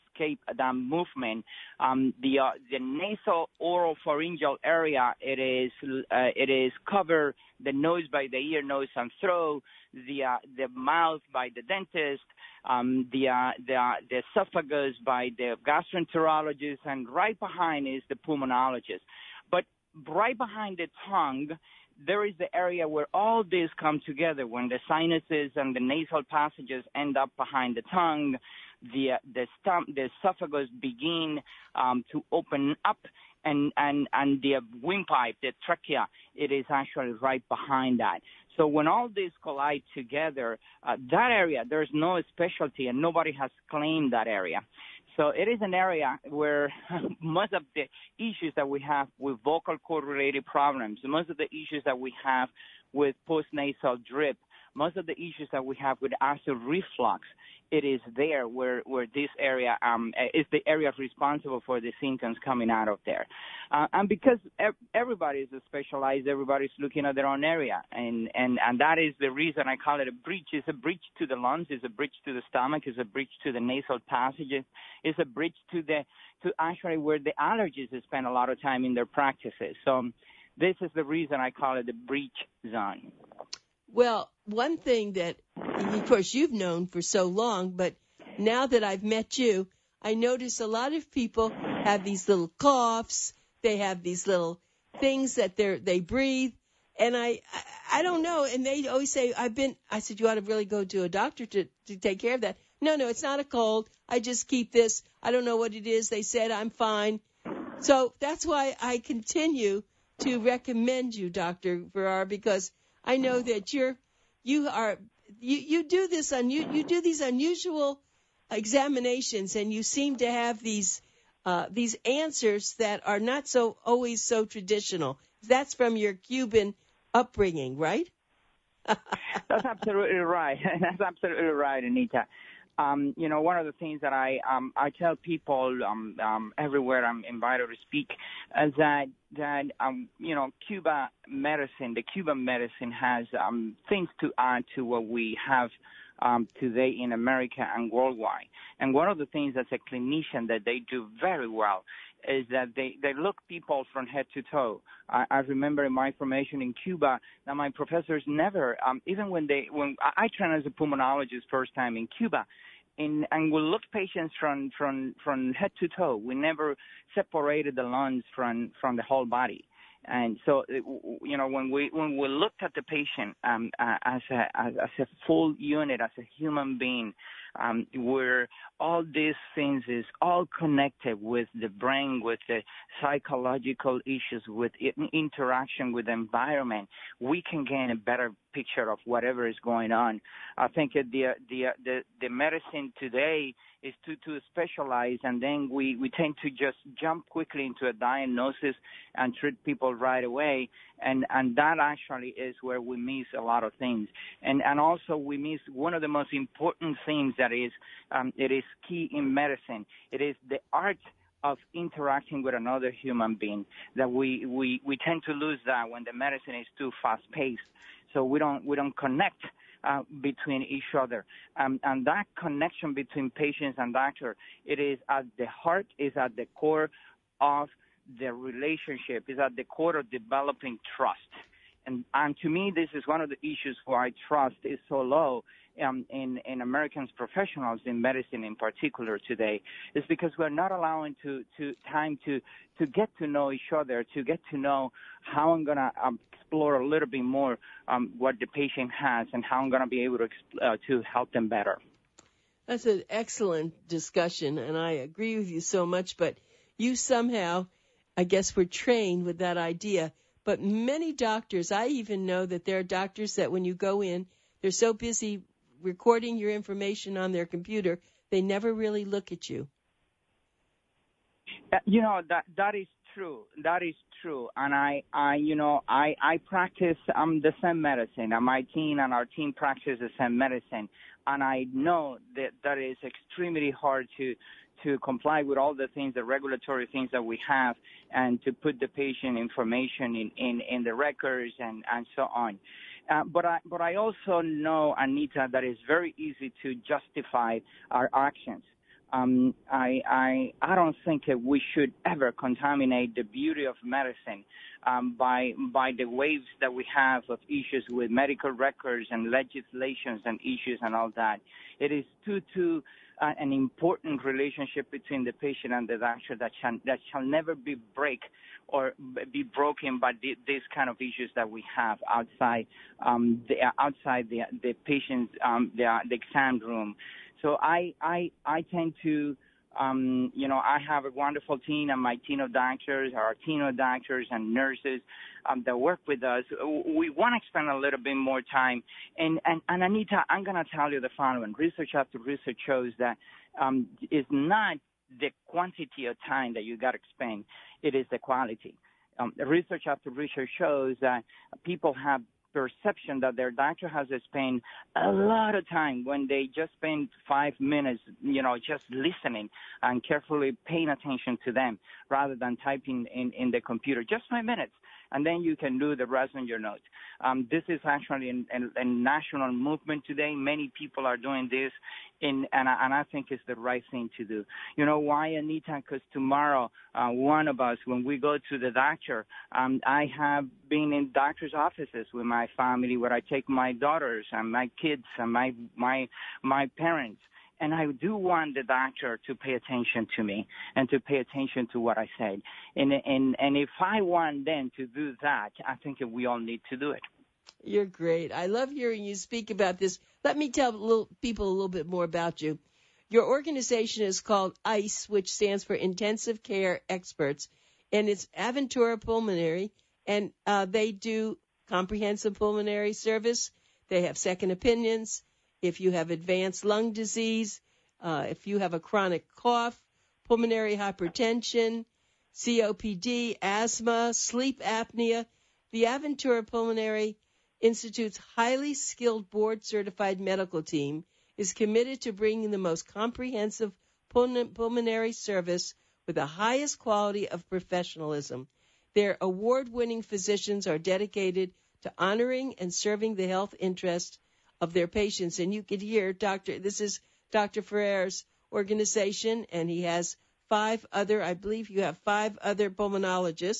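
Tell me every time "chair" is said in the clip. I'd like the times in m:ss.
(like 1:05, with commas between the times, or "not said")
not said.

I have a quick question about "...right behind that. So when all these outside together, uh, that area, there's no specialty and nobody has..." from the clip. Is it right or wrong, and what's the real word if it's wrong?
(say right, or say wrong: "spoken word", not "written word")
wrong: "collide", not "outside".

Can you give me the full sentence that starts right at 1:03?
Uh, and because everybody is specialized, everybody's looking at their own area.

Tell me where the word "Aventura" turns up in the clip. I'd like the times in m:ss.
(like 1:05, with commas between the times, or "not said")
6:48, 7:05.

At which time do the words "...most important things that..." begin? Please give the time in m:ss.
3:26.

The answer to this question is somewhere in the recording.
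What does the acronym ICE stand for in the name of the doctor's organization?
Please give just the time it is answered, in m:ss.
6:45.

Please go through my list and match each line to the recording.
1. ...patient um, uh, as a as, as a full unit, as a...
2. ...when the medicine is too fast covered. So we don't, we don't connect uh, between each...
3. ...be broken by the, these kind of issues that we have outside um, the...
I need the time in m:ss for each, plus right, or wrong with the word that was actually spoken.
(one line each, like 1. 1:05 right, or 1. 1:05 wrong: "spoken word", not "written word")
1. 2:52 right
2. 3:35 wrong: "paced", not "covered"
3. 5:19 right.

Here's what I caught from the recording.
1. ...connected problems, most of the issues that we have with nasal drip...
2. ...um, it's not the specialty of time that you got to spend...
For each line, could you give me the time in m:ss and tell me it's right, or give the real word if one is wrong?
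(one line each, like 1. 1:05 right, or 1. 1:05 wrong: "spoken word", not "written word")
1. 0:50 wrong: "related", not "connected"
2. 5:43 wrong: "quantity", not "specialty".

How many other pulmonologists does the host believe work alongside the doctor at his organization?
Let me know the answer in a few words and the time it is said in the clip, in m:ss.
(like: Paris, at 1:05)
5, at 7:31.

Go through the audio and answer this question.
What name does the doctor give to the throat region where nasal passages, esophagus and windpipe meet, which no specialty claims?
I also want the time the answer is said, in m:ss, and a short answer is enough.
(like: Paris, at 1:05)
the breach zone, at 1:21.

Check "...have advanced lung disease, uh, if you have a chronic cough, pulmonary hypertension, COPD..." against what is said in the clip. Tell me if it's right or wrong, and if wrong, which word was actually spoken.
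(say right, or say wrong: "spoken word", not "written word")
right.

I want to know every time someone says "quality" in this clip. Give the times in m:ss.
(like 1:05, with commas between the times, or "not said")
5:48, 7:16.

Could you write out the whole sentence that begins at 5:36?
We want to spend a little bit more time.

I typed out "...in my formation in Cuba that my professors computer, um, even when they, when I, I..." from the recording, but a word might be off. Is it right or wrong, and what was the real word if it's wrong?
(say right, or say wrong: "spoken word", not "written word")
wrong: "never", not "computer".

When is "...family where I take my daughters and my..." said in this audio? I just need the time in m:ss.
6:22.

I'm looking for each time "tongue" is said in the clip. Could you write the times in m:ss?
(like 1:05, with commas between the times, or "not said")
0:21, 0:27.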